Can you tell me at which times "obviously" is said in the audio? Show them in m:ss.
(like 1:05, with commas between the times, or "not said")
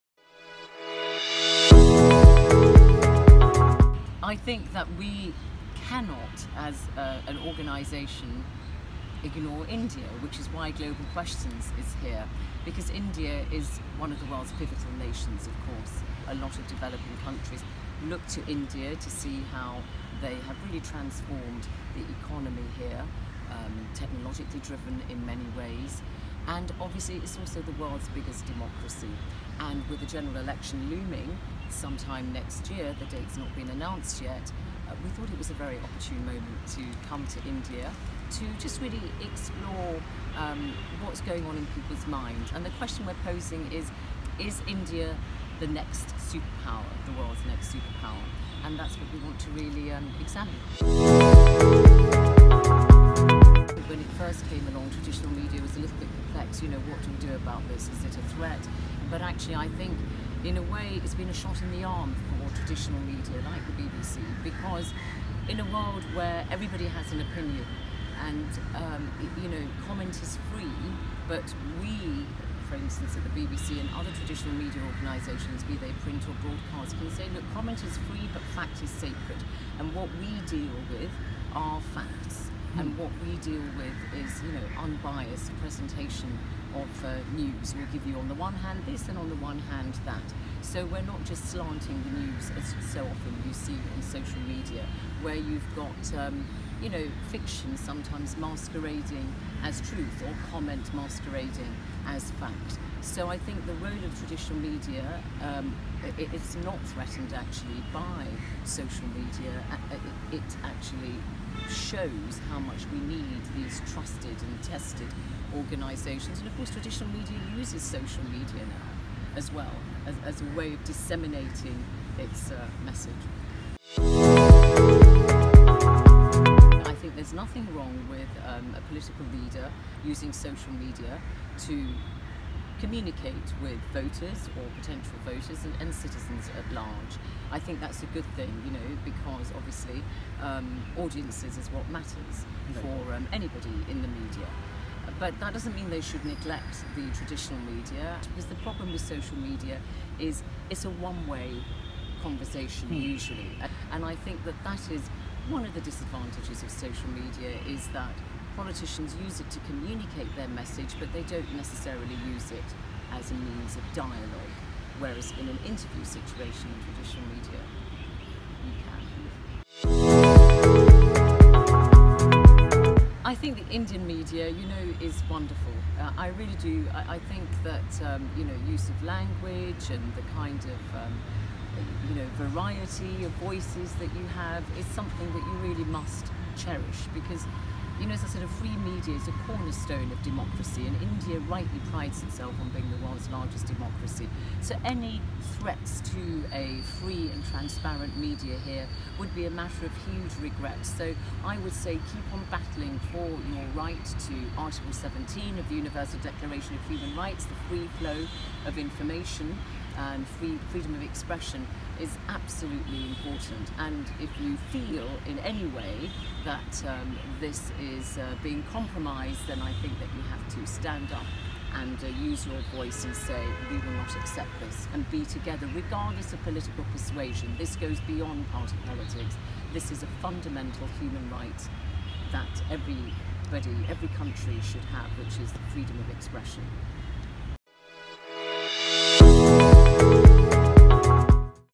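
0:26, 2:19.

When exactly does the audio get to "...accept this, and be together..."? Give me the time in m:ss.
3:44.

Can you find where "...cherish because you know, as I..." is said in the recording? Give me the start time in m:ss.
3:06.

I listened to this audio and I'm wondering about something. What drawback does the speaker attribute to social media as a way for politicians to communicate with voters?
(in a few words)
one-way conversation.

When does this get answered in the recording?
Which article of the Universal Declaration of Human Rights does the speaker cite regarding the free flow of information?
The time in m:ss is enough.
3:24.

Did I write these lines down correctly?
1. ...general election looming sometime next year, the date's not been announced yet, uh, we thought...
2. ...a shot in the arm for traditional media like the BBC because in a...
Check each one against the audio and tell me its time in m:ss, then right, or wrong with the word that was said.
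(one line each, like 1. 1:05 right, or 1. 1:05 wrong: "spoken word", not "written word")
1. 0:30 right
2. 1:01 right.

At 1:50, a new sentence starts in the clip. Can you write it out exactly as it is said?
It, it actually shows how much we need these trusted and tested organisations.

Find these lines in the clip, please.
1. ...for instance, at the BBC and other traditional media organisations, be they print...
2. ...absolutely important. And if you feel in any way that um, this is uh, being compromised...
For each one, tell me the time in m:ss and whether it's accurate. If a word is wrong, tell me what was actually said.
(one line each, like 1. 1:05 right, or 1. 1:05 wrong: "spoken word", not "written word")
1. 1:12 right
2. 3:32 right.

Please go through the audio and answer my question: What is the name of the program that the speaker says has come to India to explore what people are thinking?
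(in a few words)
Global Questions.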